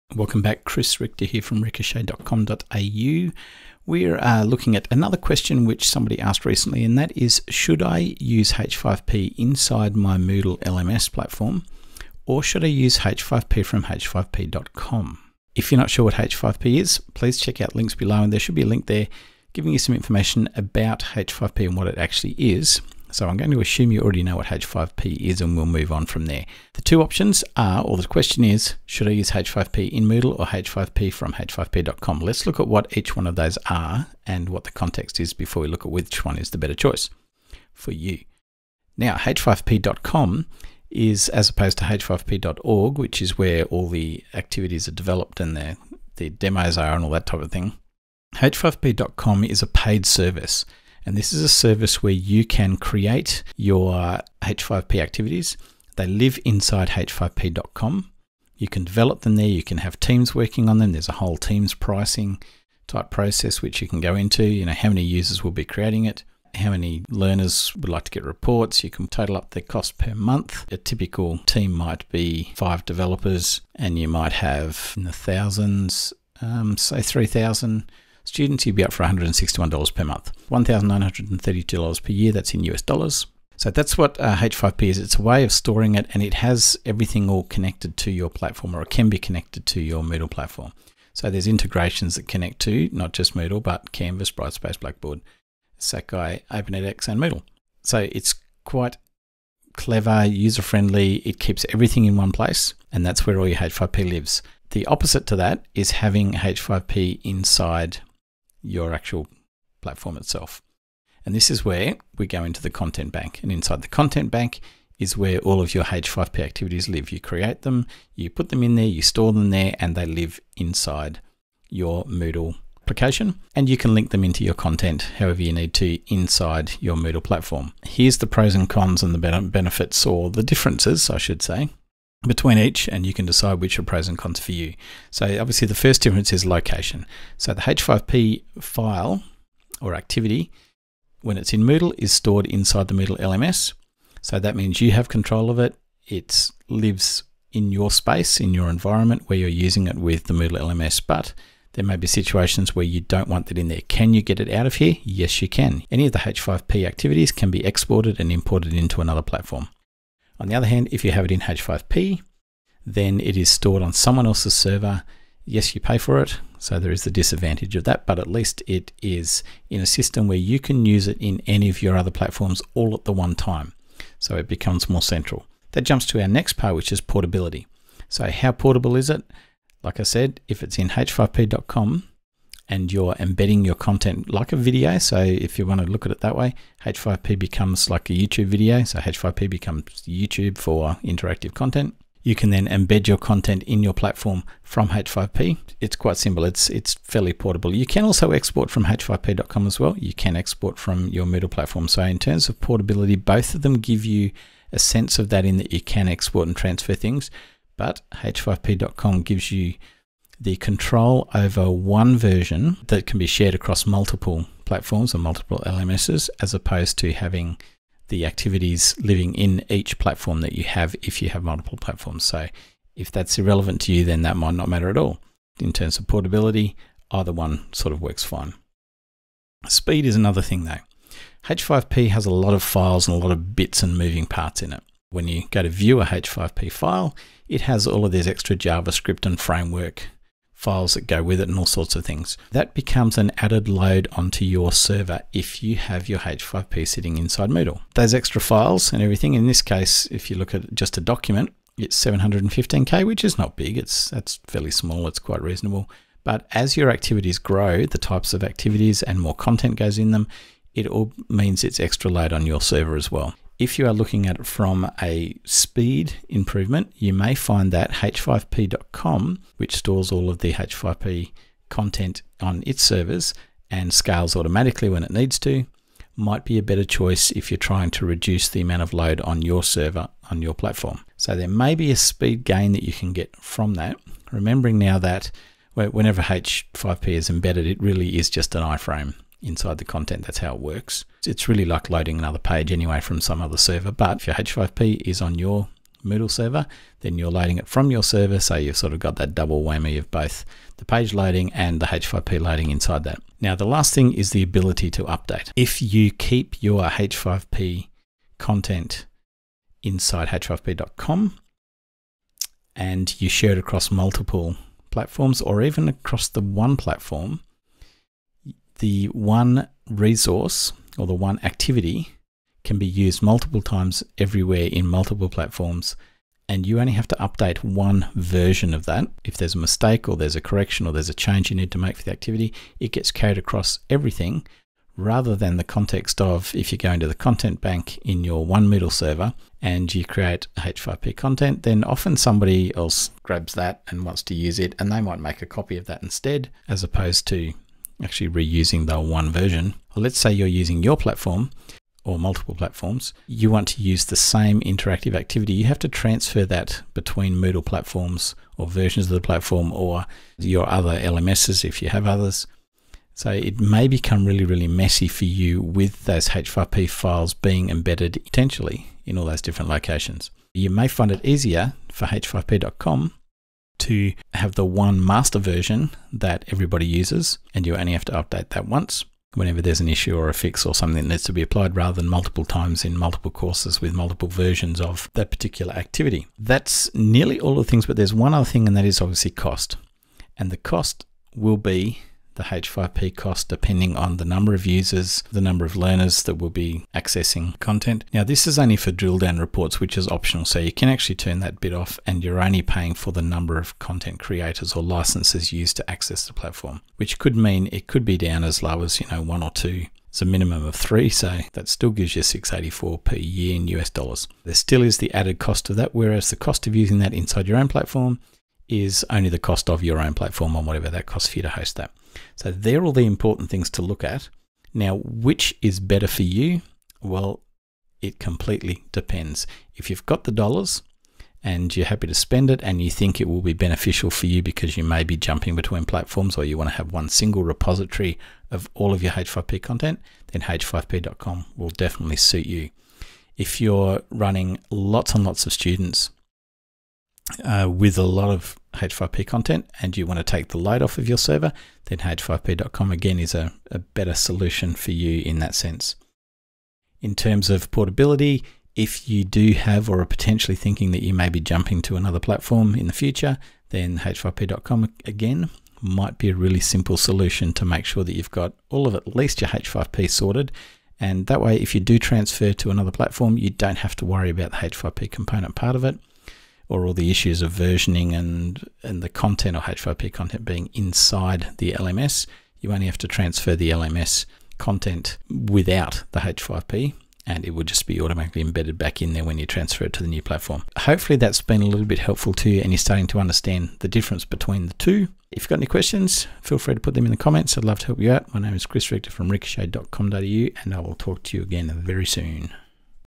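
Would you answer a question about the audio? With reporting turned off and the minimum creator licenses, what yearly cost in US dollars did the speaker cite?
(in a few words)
$684.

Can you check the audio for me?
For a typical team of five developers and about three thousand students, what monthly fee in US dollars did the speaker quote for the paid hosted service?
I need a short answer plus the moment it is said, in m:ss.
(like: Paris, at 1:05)
$161, at 1:19.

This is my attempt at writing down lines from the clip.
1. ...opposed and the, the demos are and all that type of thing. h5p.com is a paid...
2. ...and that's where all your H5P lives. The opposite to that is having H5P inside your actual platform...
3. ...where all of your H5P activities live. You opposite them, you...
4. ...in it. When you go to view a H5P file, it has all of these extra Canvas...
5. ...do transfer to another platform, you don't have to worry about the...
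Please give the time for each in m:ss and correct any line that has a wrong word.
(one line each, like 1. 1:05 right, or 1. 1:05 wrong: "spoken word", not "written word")
1. 0:44 wrong: "developed", not "opposed"
2. 1:42 right
3. 1:55 wrong: "create", not "opposite"
4. 3:54 wrong: "JavaScript", not "Canvas"
5. 7:51 right.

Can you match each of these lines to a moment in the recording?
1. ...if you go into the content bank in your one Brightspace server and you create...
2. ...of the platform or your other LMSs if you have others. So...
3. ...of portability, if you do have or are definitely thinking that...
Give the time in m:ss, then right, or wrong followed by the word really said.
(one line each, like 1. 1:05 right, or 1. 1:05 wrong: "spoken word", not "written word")
1. 5:36 wrong: "Moodle", not "Brightspace"
2. 5:59 right
3. 7:37 wrong: "potentially", not "definitely".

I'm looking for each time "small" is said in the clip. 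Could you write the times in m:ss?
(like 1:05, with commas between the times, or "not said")
4:14.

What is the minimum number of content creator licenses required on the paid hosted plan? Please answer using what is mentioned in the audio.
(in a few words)
3.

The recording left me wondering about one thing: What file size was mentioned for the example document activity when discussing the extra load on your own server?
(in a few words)
715k.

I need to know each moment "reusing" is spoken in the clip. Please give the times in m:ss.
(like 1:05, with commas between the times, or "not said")
5:48.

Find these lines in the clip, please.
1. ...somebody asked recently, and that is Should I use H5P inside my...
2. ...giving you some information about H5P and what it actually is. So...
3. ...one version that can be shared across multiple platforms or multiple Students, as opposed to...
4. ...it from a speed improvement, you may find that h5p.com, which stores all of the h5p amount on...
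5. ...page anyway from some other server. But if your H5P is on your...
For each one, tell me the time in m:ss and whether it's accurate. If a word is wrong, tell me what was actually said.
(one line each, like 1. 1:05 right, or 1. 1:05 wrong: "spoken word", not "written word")
1. 0:05 right
2. 0:19 right
3. 3:31 wrong: "LMSs", not "Students"
4. 4:24 wrong: "content", not "amount"
5. 4:52 right.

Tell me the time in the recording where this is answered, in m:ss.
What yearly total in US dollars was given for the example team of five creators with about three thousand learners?
1:20.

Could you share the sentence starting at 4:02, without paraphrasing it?
That becomes an added load onto your server if you have your H5P sitting inside Moodle.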